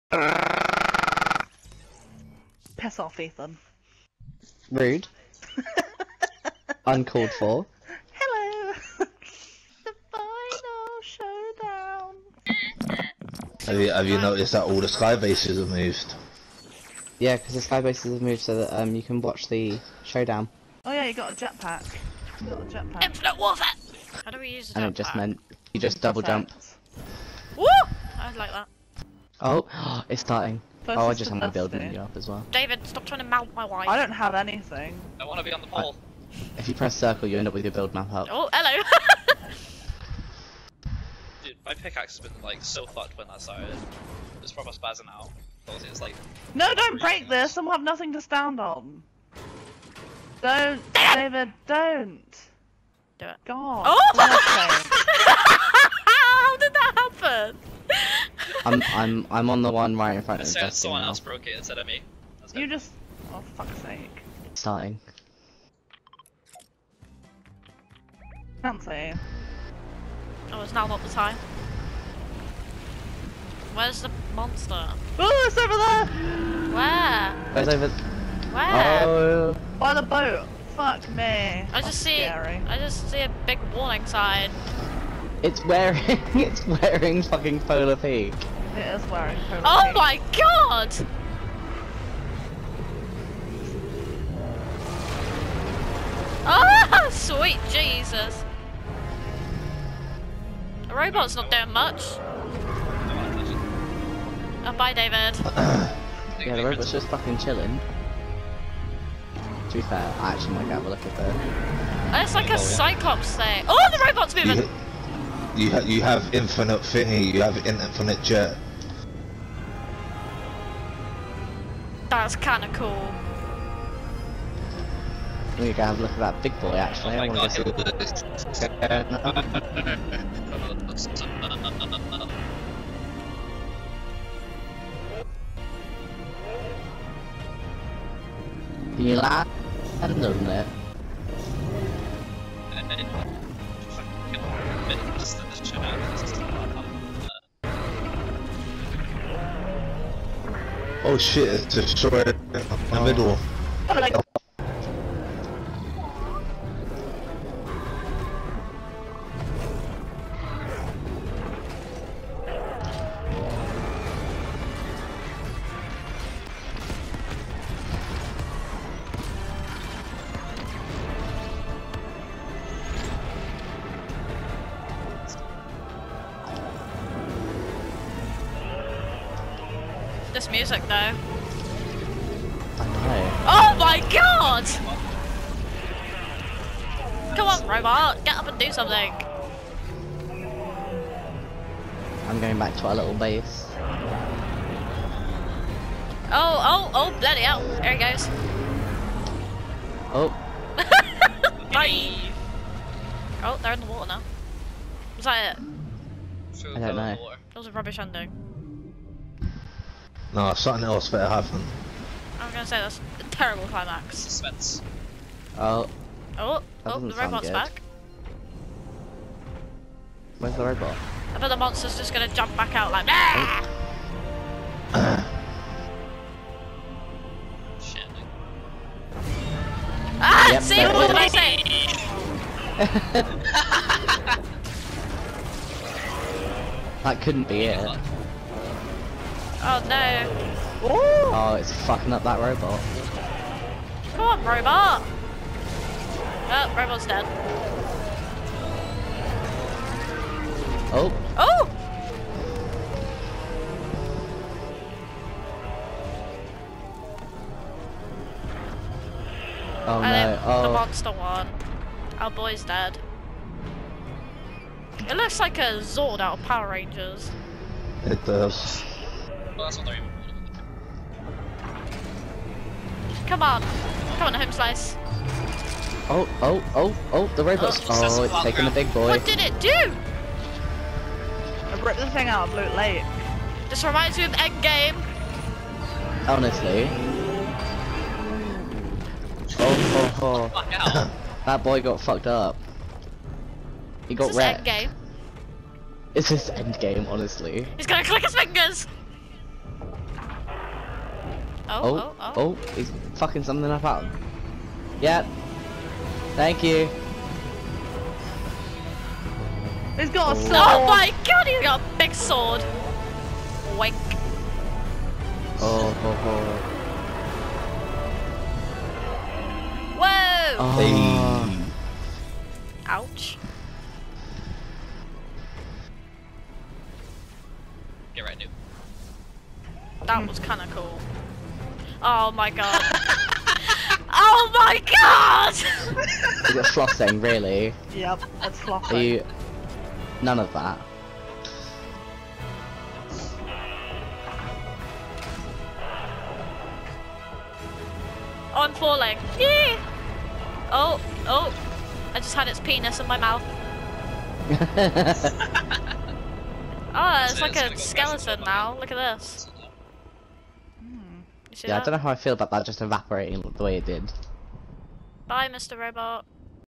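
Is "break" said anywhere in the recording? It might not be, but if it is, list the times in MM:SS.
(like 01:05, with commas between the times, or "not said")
00:46.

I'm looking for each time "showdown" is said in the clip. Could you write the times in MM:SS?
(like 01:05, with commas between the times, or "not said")
00:11, 00:20.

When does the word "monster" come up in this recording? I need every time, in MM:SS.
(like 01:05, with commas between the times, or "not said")
01:14, 03:41, 04:20.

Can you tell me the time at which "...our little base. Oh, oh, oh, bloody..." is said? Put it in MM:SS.
03:12.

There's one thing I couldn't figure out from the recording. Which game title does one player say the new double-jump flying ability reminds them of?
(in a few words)
Infinite Warfare.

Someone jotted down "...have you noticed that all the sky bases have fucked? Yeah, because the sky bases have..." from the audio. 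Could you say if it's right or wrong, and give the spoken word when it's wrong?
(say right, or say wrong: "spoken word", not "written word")
wrong: "moved", not "fucked".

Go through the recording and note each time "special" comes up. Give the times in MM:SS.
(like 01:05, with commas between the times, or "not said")
not said.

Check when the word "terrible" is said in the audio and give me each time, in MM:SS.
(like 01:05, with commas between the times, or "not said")
03:33.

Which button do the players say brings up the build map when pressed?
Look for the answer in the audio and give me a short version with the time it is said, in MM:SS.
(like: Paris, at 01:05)
circle, at 00:36.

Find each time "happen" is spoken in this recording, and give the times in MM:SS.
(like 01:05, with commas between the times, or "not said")
00:56, 03:31.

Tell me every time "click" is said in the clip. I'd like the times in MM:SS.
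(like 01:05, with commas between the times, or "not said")
04:58.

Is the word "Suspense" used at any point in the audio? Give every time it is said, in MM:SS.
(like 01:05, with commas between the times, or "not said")
03:34.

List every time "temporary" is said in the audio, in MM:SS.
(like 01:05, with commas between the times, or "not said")
not said.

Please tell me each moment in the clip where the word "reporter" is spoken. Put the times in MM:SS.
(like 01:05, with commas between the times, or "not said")
not said.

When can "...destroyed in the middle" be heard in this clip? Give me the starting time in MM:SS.
02:31.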